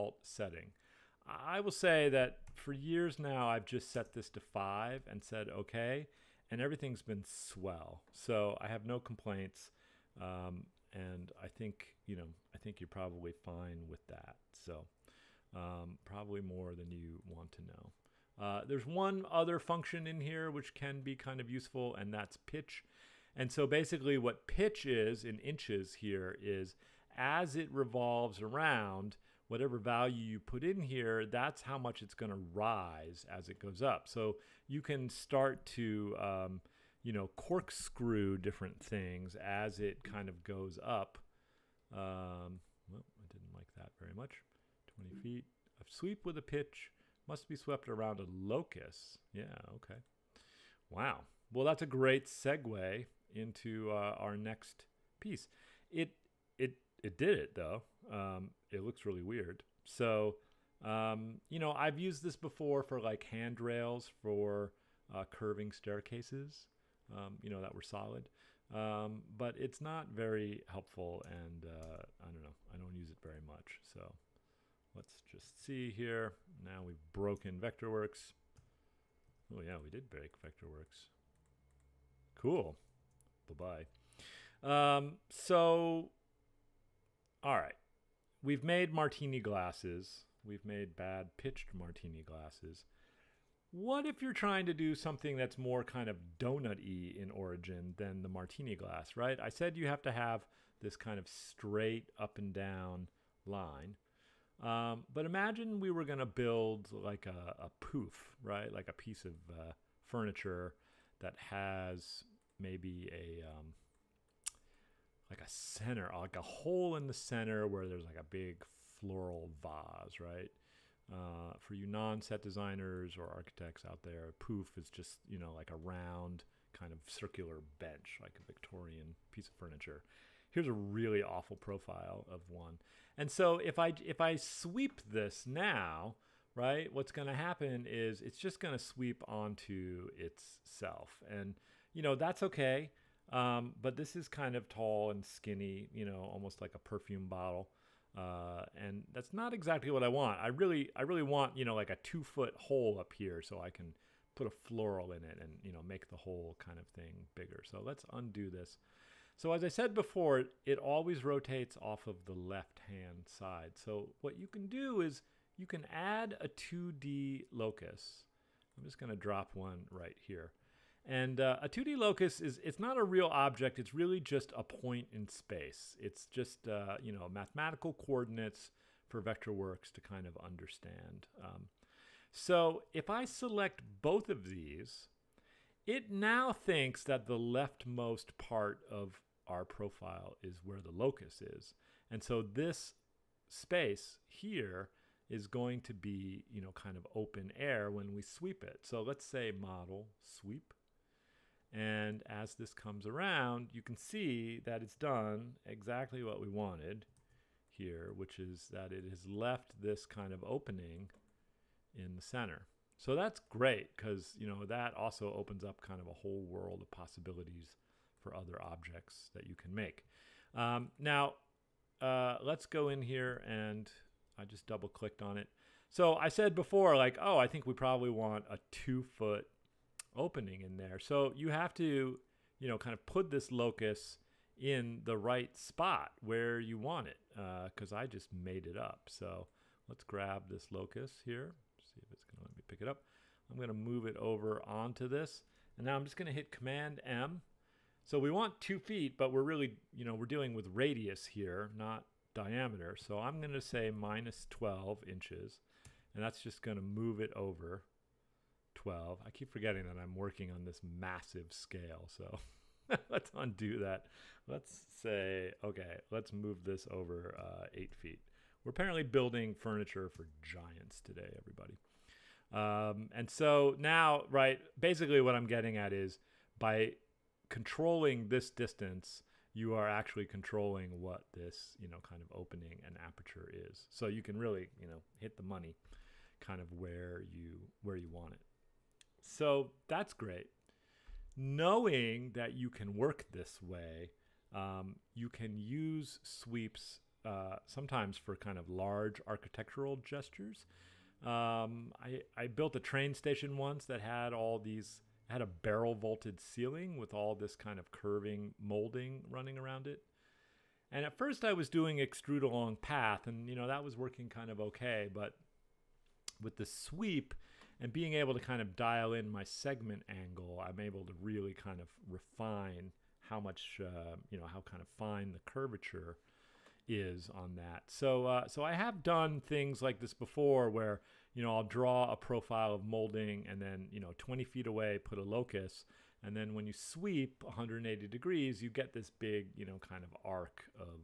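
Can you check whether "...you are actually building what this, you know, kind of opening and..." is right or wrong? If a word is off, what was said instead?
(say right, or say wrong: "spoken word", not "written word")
wrong: "controlling", not "building".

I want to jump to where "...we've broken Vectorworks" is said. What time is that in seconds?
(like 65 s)
76 s.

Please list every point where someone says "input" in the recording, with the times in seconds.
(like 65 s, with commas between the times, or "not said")
not said.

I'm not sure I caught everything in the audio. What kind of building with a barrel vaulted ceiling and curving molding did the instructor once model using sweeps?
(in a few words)
train station.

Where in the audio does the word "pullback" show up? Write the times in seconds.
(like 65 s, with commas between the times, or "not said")
not said.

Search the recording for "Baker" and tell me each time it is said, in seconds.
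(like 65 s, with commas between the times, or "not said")
not said.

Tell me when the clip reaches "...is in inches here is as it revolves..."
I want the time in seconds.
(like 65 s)
24 s.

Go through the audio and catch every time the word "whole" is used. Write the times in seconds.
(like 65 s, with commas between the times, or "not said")
156 s, 216 s.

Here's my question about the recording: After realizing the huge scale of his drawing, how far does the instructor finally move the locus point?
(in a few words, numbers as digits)
8 feet.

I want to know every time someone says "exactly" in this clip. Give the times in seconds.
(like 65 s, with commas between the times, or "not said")
149 s, 205 s.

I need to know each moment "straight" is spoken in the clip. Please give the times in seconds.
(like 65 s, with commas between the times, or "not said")
101 s.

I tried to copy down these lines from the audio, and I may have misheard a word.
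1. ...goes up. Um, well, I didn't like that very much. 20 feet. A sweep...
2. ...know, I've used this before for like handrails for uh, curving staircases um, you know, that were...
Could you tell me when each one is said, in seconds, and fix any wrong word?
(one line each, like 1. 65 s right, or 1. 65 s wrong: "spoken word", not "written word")
1. 40 s right
2. 61 s right.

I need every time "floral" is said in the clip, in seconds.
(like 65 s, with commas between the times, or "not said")
118 s, 154 s.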